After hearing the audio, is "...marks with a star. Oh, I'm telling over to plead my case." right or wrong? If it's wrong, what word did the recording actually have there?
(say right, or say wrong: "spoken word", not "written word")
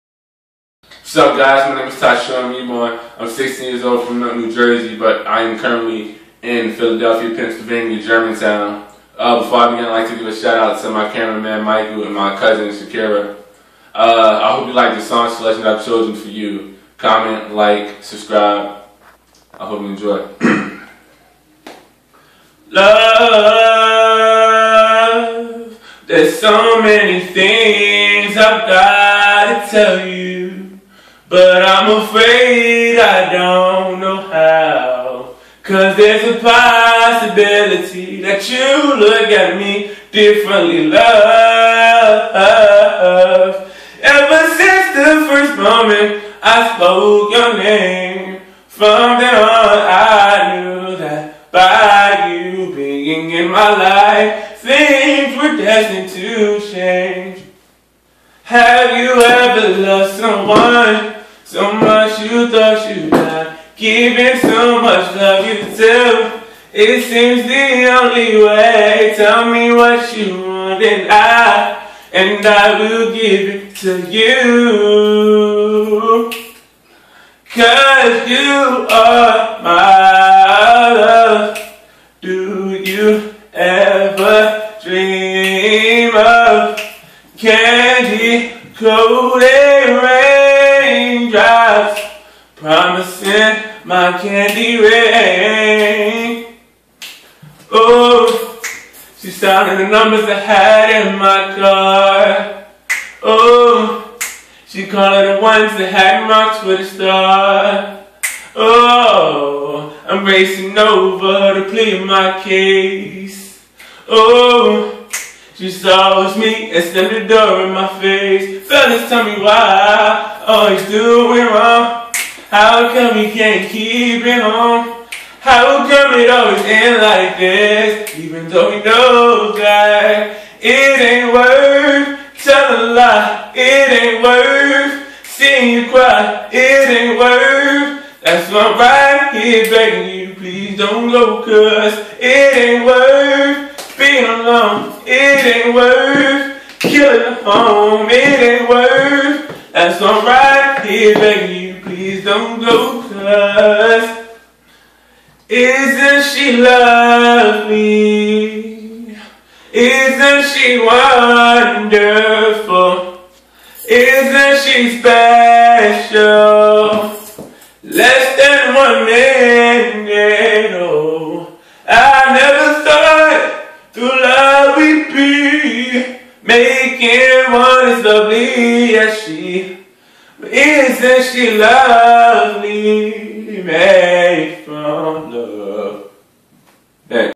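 wrong: "racing", not "telling".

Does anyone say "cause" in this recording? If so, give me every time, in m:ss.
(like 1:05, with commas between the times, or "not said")
0:35, 1:17, 2:21, 2:33.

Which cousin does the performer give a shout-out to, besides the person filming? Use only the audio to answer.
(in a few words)
Shakira.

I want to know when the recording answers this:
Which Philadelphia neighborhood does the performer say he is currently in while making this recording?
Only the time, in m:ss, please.
0:08.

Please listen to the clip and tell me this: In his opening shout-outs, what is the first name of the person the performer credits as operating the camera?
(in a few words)
Michael.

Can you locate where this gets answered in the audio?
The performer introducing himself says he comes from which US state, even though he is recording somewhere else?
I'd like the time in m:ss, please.
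0:04.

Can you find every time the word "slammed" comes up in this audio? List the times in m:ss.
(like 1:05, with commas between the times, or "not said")
1:56.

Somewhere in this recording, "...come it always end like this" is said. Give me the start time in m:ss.
2:05.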